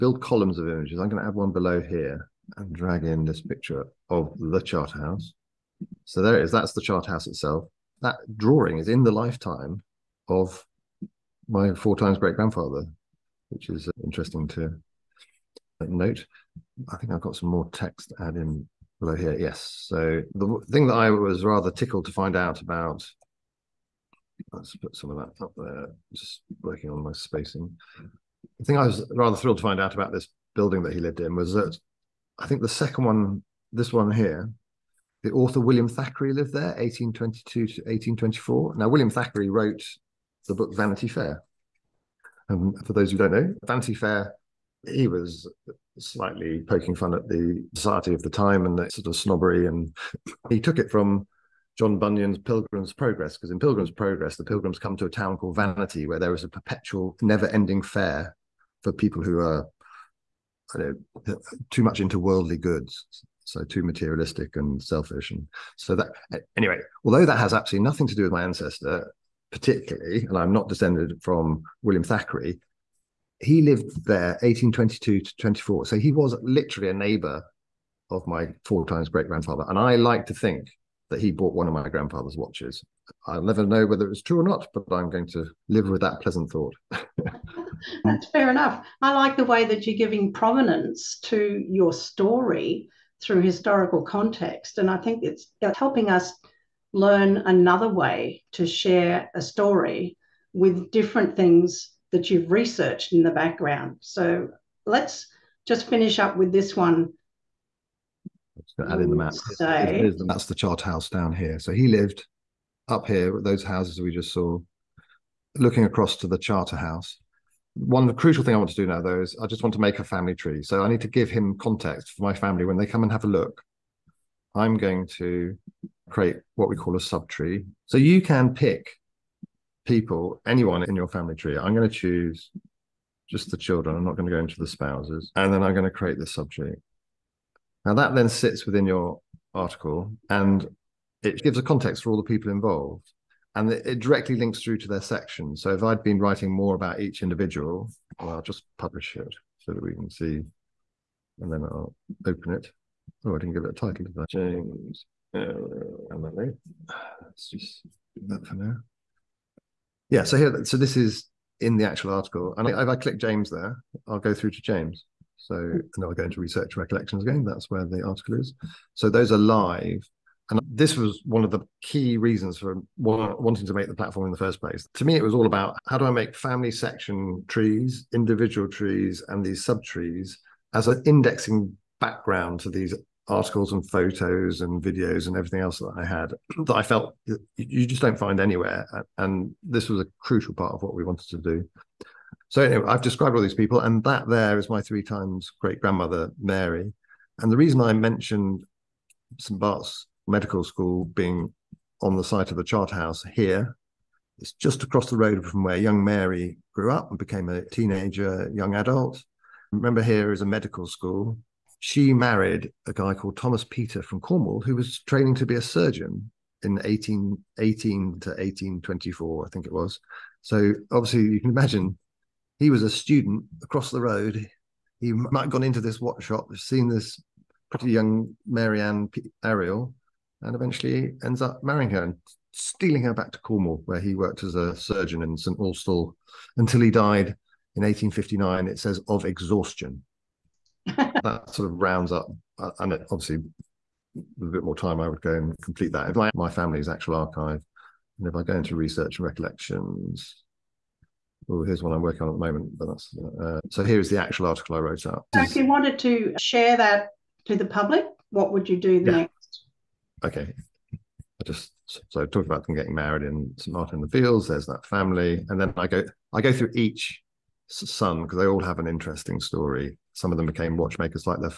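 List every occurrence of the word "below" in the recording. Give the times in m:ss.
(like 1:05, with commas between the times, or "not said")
0:01, 0:19.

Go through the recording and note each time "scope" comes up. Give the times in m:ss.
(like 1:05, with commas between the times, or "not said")
not said.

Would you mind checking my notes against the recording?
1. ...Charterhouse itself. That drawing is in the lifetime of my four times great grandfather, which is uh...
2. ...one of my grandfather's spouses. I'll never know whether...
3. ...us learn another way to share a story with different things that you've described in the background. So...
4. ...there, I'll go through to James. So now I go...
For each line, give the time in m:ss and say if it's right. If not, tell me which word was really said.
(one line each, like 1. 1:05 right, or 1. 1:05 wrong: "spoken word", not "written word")
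1. 0:06 right
2. 1:21 wrong: "watches", not "spouses"
3. 1:36 wrong: "researched", not "described"
4. 2:43 right.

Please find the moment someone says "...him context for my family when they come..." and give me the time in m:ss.
2:01.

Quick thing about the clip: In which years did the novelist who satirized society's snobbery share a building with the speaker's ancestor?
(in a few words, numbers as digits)
1822 to 1824.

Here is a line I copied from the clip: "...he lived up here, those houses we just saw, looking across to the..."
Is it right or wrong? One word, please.
right.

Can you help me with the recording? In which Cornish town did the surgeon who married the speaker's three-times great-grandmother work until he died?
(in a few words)
St Austell.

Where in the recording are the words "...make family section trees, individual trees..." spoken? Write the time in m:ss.
2:56.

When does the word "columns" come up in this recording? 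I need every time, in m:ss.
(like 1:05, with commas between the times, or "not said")
0:00.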